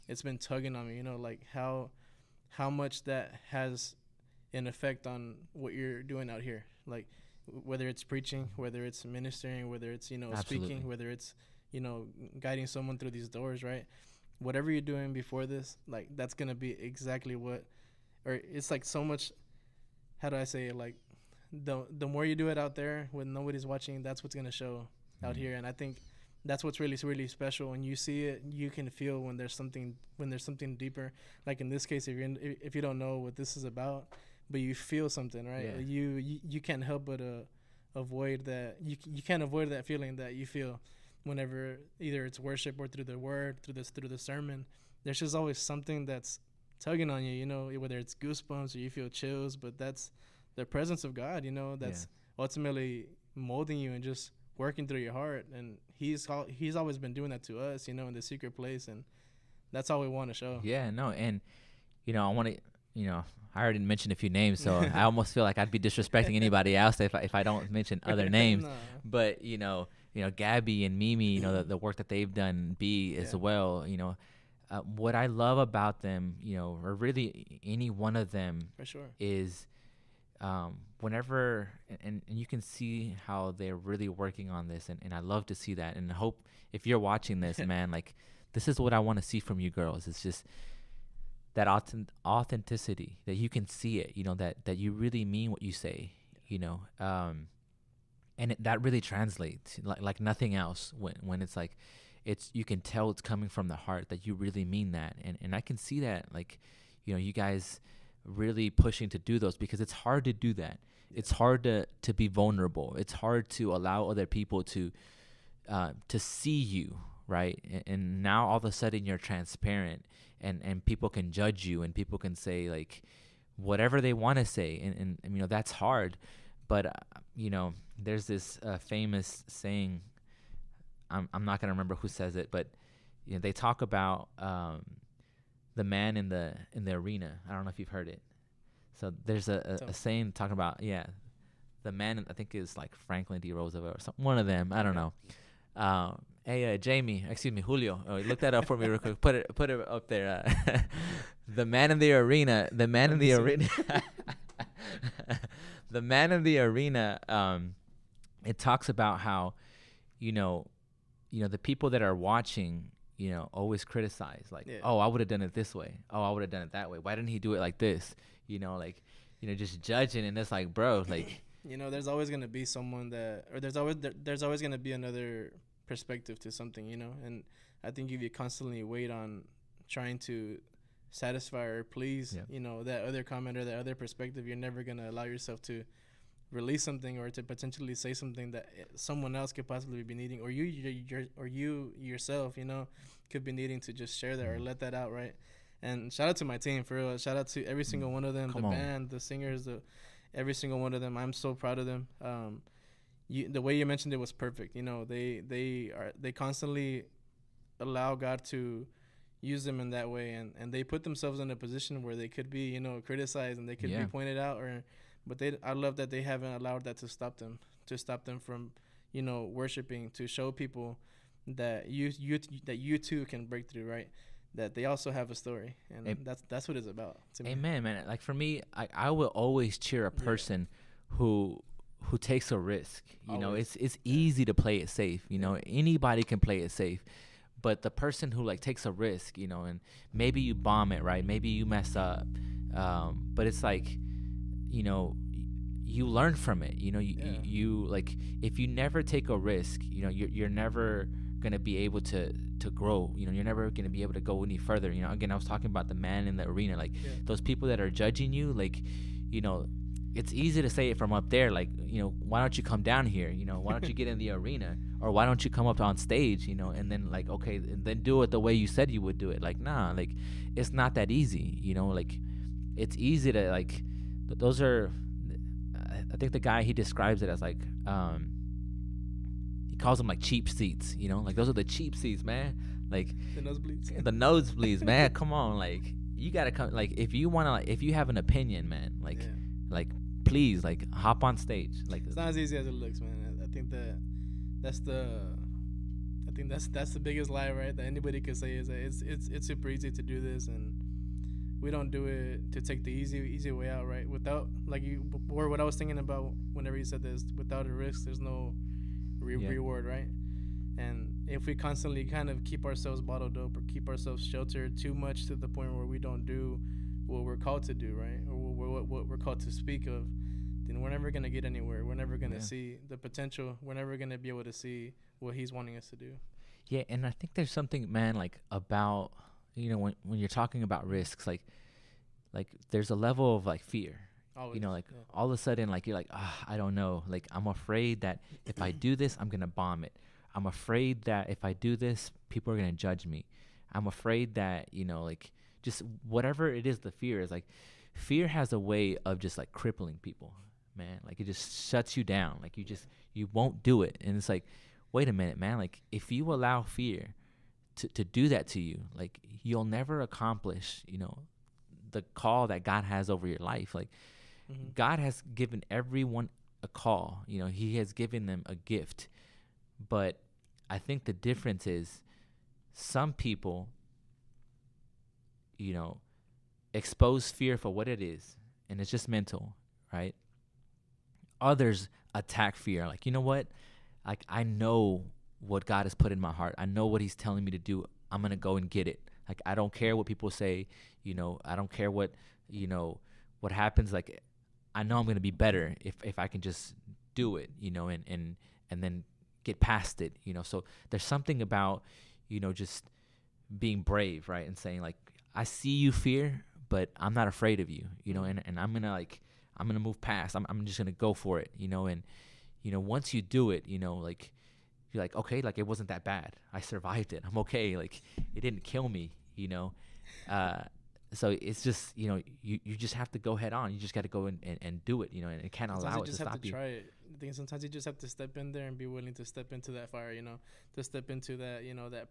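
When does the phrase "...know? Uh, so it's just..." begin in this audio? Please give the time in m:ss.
6:59.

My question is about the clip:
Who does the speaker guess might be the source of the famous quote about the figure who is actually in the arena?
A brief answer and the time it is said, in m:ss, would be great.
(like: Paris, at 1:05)
Franklin D. Roosevelt, at 2:22.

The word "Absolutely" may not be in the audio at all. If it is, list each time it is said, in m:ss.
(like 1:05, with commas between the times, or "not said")
0:10.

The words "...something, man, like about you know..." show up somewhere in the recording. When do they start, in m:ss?
5:27.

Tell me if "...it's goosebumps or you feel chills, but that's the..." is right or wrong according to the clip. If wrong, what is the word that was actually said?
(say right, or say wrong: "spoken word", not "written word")
right.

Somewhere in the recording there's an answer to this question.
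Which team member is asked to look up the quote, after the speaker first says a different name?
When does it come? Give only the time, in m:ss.
2:27.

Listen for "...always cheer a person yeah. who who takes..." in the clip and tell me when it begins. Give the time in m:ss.
3:49.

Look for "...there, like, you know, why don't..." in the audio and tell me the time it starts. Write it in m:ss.
4:21.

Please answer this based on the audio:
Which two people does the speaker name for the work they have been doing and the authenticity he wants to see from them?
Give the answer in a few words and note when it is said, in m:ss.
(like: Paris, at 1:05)
Gabby and Mimi, at 1:10.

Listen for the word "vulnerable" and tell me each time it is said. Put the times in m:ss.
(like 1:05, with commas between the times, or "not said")
1:52.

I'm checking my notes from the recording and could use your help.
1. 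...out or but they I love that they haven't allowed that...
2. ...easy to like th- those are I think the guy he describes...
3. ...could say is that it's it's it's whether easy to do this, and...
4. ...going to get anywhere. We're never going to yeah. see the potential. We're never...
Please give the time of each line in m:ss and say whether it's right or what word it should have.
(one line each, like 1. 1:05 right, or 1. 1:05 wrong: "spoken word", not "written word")
1. 3:34 right
2. 4:32 right
3. 4:58 wrong: "super", not "whether"
4. 5:21 right.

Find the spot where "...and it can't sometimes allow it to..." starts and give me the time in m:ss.
7:05.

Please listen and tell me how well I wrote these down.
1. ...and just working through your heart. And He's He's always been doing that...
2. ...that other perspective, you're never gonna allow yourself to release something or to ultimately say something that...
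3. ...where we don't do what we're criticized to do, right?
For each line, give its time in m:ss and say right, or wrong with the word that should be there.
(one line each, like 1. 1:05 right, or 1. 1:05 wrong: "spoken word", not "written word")
1. 0:53 right
2. 3:03 wrong: "potentially", not "ultimately"
3. 5:15 wrong: "called", not "criticized".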